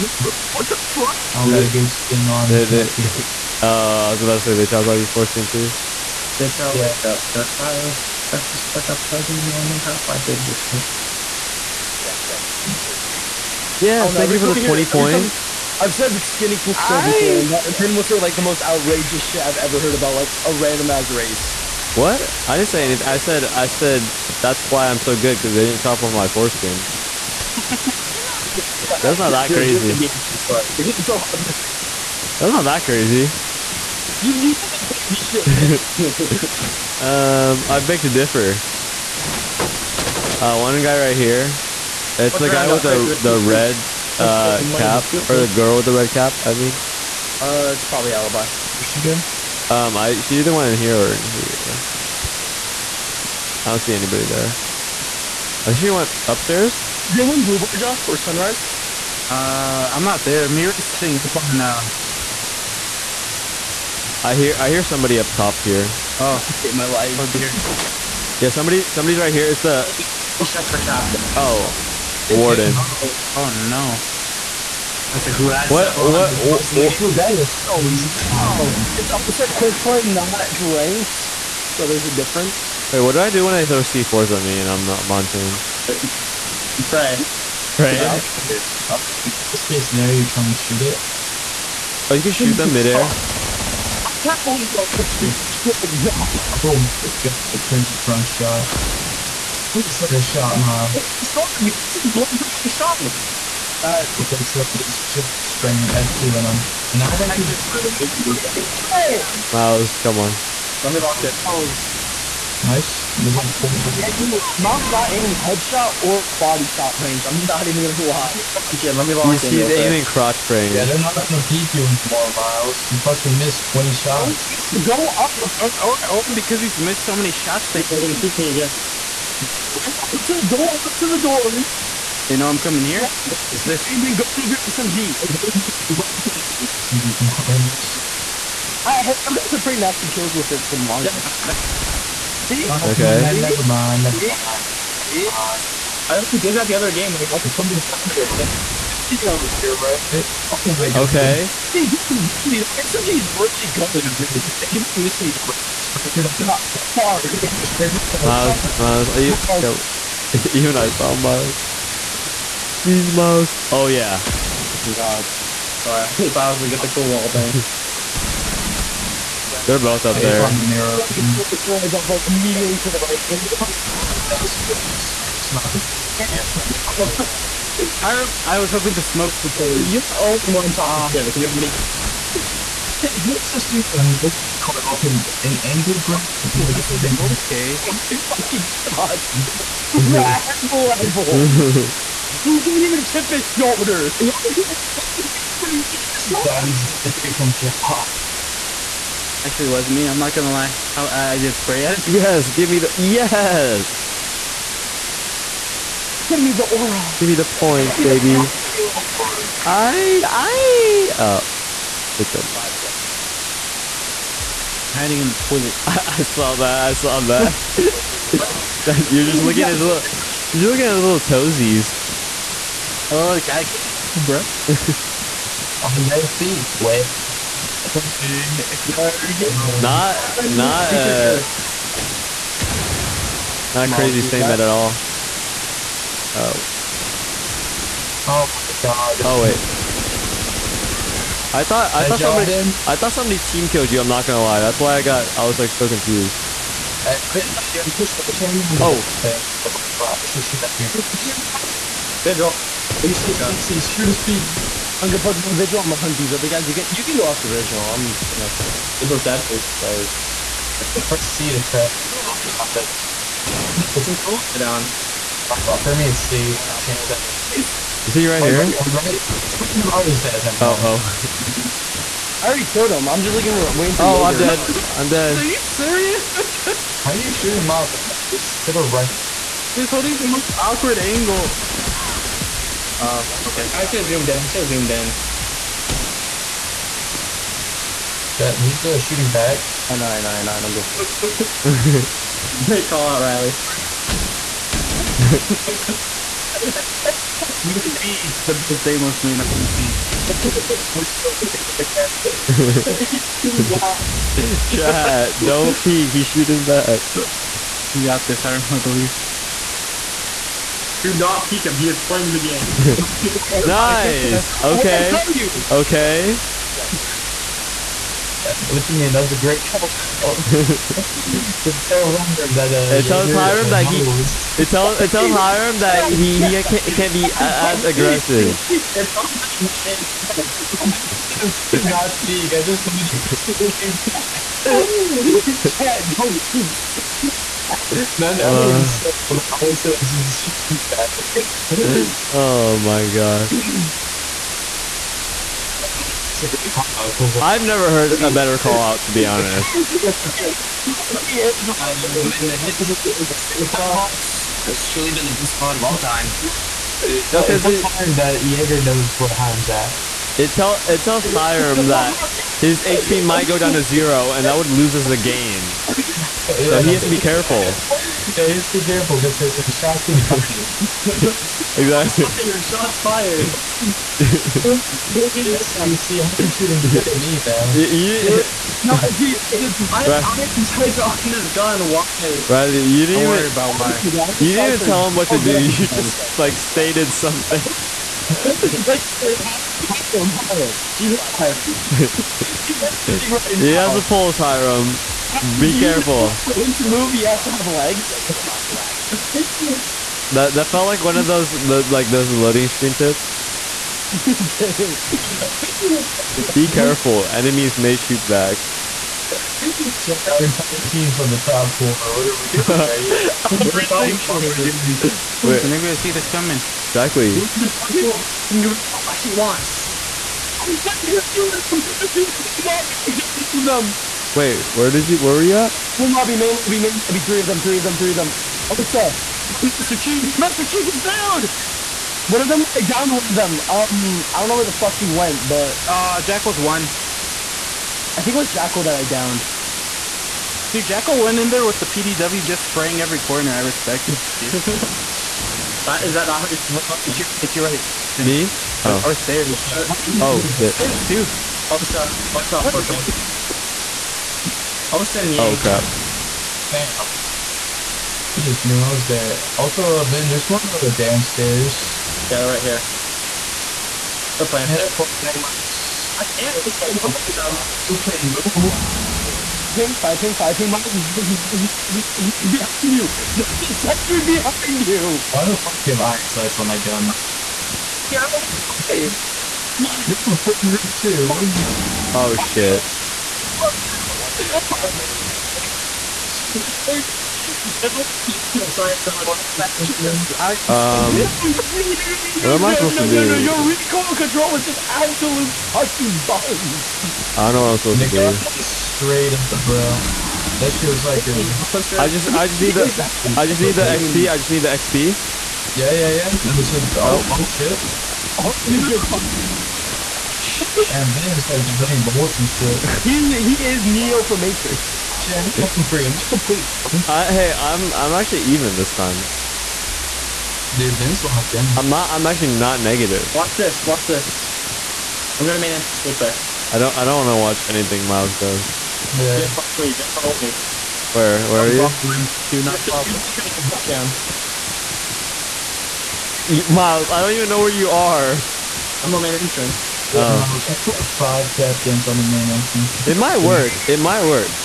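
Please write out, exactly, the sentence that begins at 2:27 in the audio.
Like, like somebody was touching it.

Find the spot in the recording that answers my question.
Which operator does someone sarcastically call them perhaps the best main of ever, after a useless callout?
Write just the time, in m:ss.
4:58.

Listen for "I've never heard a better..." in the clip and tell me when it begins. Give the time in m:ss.
5:47.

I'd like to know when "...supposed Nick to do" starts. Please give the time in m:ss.
8:17.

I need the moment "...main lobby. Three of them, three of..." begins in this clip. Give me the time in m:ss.
7:06.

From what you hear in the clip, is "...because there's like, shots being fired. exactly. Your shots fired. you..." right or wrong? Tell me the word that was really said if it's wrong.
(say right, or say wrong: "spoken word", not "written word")
right.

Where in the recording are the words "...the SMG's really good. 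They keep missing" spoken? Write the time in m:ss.
2:31.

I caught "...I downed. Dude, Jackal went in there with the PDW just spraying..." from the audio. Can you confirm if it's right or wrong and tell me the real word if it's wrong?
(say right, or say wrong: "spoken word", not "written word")
right.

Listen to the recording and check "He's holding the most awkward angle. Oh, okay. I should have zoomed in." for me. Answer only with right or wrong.
right.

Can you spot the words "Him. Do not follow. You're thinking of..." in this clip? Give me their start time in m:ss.
8:52.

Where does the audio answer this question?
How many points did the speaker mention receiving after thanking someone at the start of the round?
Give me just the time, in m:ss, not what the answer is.
0:14.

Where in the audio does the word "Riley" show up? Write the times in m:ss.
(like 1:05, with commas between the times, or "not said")
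4:53, 6:22.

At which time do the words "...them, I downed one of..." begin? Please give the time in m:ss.
7:12.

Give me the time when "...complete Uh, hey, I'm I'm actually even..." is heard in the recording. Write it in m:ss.
8:36.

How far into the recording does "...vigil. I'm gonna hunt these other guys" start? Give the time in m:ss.
4:15.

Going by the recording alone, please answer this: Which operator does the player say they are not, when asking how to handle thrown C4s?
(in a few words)
Montagne.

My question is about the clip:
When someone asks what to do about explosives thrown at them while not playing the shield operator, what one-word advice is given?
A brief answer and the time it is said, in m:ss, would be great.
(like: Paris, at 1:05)
Pray, at 1:26.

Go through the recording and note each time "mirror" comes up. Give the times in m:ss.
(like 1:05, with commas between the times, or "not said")
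2:50.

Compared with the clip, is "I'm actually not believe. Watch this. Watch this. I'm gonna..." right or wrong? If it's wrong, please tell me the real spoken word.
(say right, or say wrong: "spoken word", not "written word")
wrong: "negative", not "believe".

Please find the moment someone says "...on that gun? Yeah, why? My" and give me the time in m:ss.
7:56.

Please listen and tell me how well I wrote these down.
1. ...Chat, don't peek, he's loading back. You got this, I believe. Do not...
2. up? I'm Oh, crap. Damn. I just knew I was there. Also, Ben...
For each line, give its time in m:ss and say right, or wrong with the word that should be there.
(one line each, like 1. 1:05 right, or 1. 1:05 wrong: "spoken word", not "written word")
1. 5:04 wrong: "shooting", not "loading"
2. 7:32 right.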